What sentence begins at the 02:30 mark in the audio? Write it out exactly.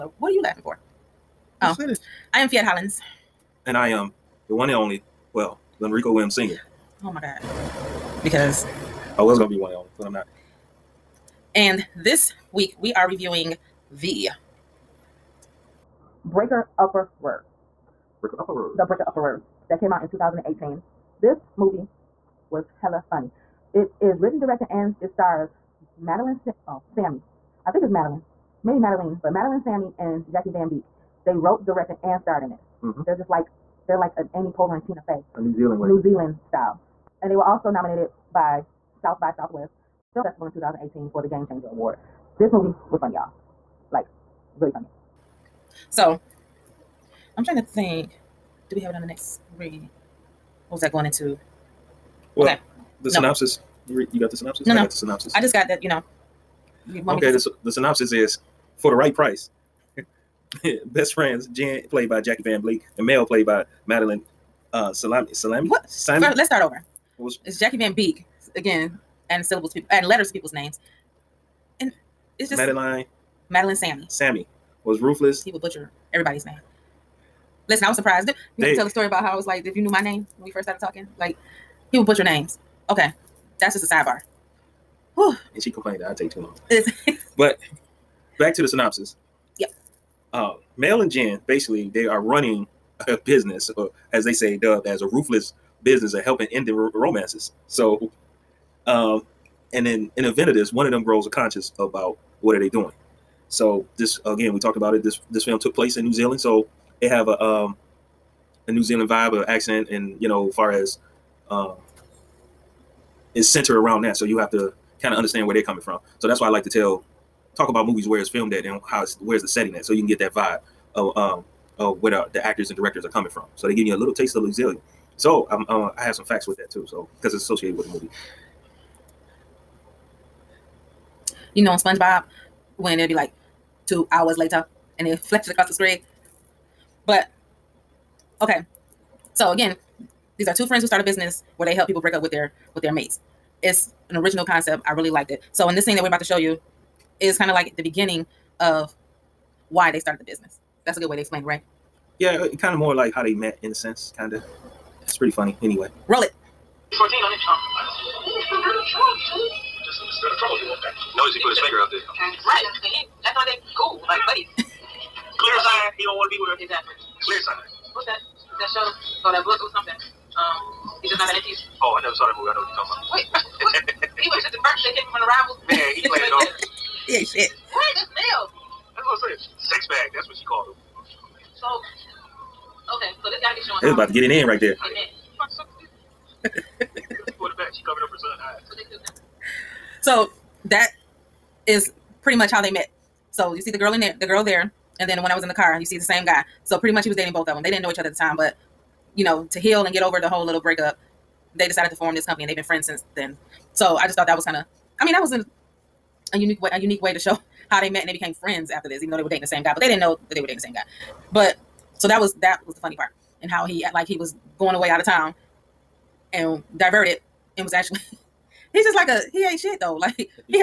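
That's a good way to explain it, right?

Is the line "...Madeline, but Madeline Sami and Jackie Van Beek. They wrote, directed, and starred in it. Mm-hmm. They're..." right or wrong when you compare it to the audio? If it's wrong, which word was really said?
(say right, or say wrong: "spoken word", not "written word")
right.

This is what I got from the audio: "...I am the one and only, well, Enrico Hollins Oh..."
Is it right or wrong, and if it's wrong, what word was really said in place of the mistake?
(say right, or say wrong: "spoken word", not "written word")
wrong: "Williams", not "Hollins".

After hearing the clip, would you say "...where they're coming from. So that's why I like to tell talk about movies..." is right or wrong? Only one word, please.
right.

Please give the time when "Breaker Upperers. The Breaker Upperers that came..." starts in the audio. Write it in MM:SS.
00:18.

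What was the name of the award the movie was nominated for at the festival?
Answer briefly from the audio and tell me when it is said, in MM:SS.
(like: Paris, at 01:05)
Game Changer Award, at 00:41.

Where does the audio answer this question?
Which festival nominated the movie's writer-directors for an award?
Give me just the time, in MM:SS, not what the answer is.
00:38.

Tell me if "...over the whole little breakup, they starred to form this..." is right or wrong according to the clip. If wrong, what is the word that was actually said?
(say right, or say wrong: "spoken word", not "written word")
wrong: "decided", not "starred".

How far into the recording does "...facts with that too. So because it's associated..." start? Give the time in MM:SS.
02:06.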